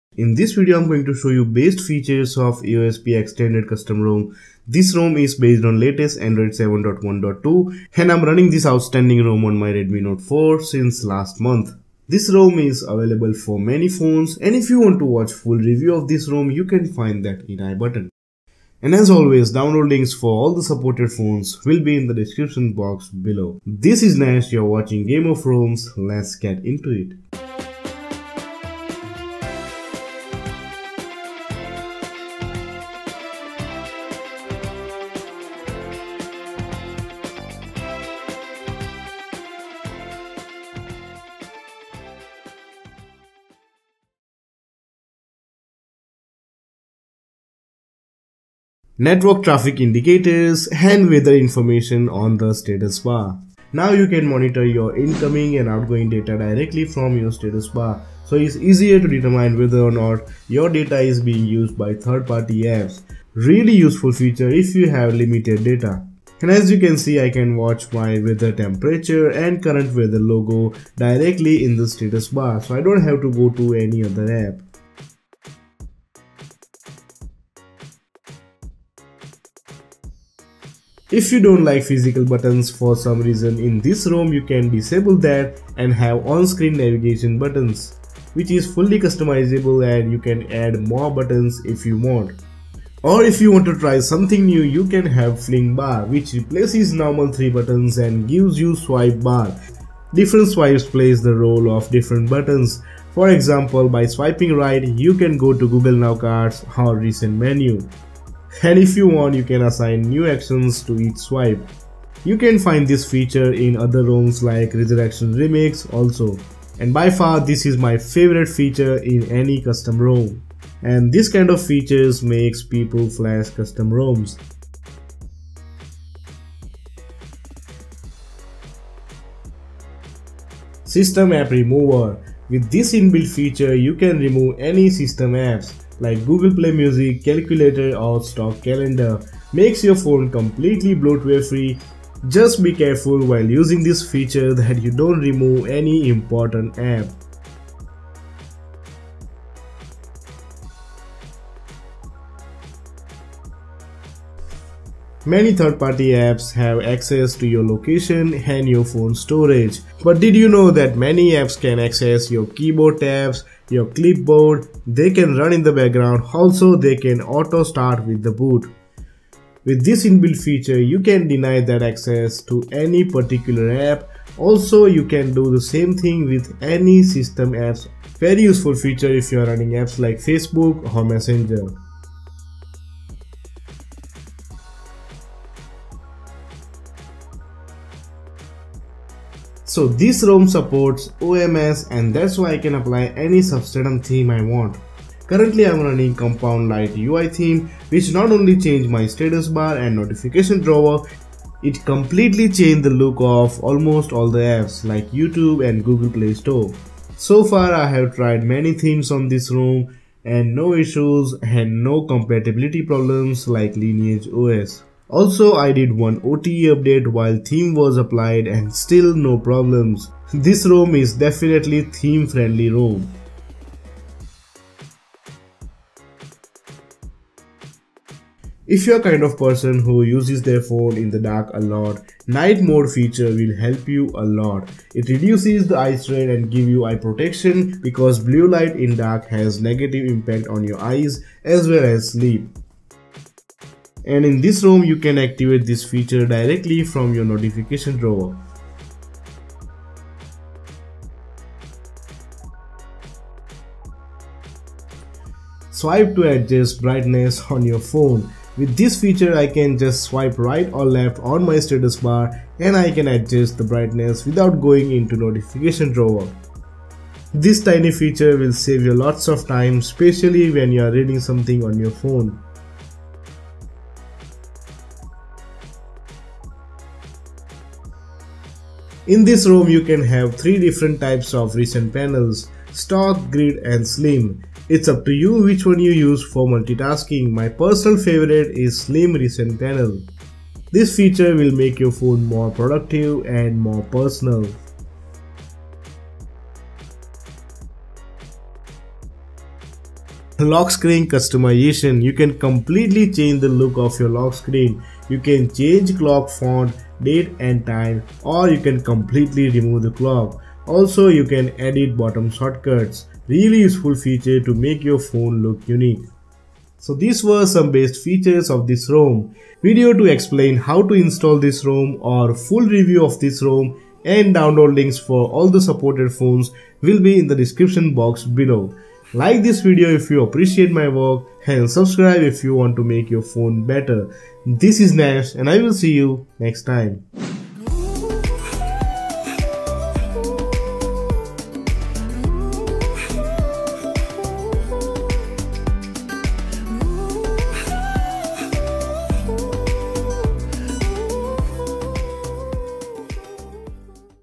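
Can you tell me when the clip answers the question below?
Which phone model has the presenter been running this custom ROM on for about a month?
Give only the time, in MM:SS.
00:09.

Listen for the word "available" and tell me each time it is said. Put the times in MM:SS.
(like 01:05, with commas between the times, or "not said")
00:12.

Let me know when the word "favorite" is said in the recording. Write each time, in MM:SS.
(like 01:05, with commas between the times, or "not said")
01:57, 04:47.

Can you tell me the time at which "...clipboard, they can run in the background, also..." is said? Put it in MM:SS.
02:43.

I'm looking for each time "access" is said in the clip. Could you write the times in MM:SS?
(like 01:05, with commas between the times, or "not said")
02:36, 02:41, 02:51.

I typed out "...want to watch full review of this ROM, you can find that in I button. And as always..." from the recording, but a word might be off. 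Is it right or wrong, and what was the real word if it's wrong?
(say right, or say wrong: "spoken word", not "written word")
right.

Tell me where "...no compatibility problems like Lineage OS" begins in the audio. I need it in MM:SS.
03:31.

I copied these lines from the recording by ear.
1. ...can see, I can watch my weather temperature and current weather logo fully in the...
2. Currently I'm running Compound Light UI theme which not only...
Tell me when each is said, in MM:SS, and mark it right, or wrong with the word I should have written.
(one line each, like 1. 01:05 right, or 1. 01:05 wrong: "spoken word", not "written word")
1. 01:06 wrong: "directly", not "fully"
2. 03:15 right.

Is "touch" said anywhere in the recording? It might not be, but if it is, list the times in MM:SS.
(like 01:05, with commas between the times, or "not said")
not said.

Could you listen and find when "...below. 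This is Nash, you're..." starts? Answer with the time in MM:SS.
00:23.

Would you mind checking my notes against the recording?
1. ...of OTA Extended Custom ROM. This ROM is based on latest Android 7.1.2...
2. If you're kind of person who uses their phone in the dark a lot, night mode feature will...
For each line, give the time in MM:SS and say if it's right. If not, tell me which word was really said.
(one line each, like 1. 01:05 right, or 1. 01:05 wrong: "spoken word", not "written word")
1. 00:02 wrong: "AOSP", not "OTA"
2. 03:48 right.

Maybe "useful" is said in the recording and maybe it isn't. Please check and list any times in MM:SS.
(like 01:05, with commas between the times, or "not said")
01:03, 02:58, 05:13.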